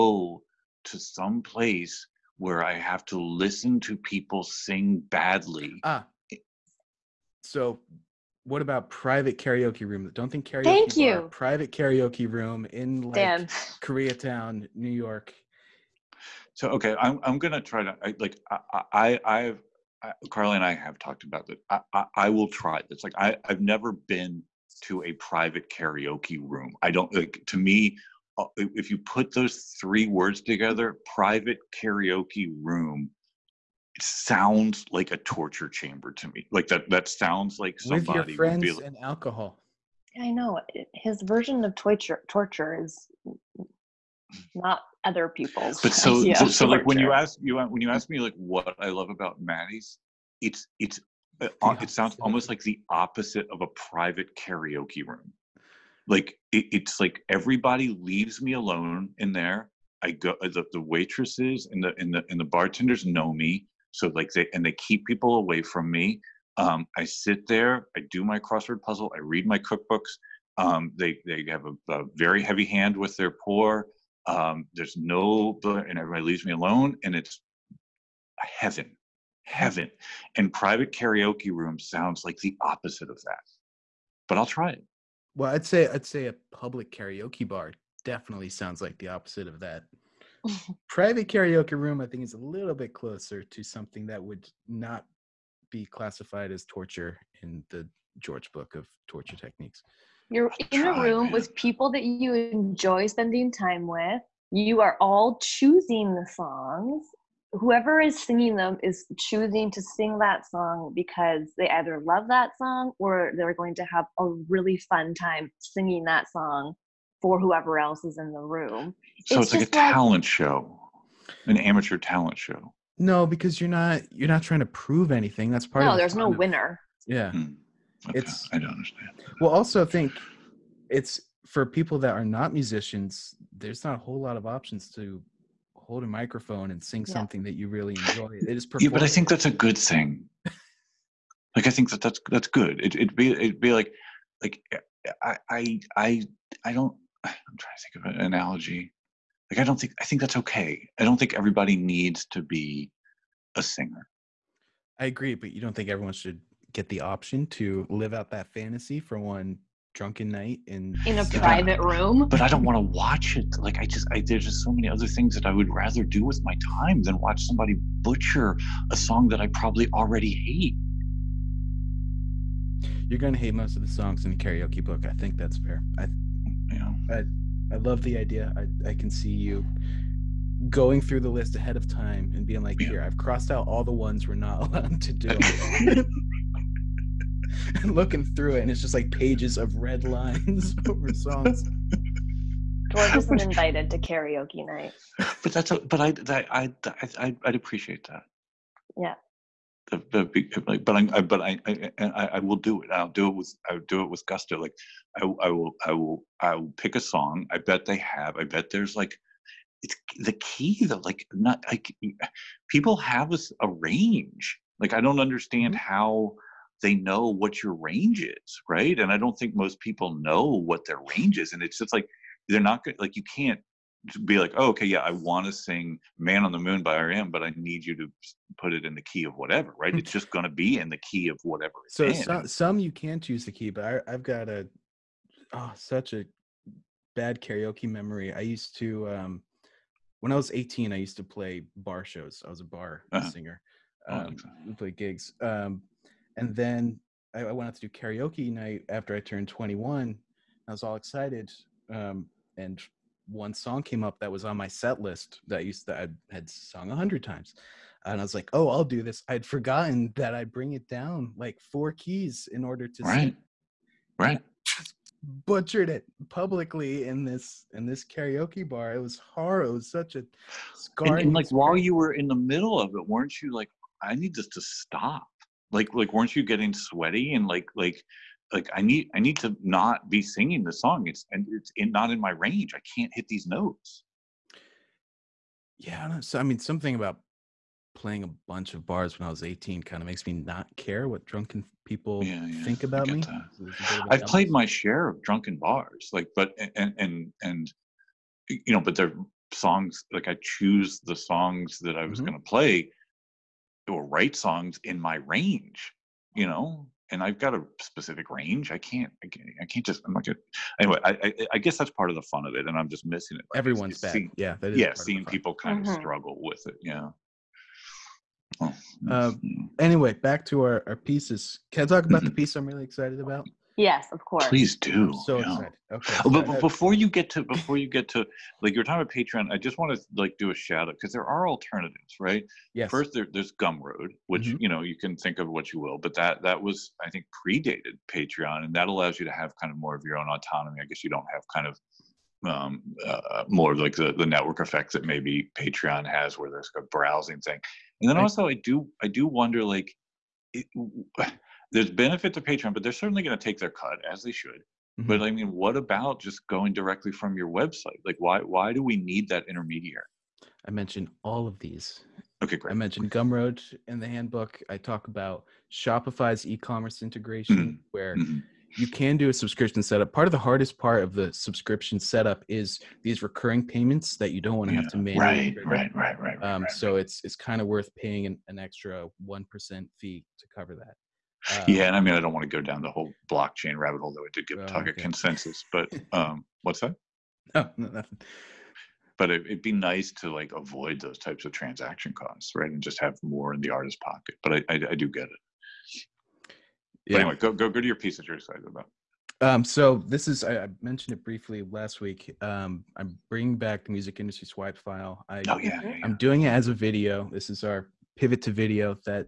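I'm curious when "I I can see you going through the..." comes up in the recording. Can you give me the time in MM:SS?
02:58.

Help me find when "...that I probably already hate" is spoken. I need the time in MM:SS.
02:49.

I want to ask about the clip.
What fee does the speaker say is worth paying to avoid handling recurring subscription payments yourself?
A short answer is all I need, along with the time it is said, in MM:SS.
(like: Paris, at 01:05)
1%, at 06:19.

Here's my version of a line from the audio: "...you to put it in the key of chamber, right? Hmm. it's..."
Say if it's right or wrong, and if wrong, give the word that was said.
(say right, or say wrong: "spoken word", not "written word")
wrong: "whatever", not "chamber".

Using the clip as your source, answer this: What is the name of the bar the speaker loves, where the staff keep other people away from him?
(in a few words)
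Maddie's.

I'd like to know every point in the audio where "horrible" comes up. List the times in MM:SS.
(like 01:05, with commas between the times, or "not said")
04:29.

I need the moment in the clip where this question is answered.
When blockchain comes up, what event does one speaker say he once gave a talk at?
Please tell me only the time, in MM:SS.
06:25.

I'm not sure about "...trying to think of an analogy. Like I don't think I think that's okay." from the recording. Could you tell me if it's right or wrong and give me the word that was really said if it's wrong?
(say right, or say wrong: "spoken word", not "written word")
right.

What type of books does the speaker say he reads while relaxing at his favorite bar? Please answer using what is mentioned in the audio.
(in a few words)
Cookbooks.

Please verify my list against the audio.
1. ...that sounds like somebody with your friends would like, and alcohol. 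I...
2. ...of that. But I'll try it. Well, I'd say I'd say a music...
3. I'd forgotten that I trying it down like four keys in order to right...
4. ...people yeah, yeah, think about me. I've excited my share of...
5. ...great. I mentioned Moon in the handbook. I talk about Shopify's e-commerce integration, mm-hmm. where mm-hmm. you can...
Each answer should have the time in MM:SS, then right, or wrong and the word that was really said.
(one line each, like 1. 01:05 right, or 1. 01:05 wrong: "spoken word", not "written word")
1. 00:36 right
2. 01:23 wrong: "public", not "music"
3. 04:19 wrong: "bring", not "trying"
4. 04:51 wrong: "played", not "excited"
5. 06:02 wrong: "Gumroad", not "Moon".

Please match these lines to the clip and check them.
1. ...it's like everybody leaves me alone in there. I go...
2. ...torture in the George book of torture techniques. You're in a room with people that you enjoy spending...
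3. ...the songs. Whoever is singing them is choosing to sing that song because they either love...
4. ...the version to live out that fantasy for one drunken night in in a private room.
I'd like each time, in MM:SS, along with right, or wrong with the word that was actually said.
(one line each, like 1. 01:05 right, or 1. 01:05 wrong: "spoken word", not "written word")
1. 00:56 right
2. 01:36 right
3. 01:46 right
4. 02:36 wrong: "option", not "version".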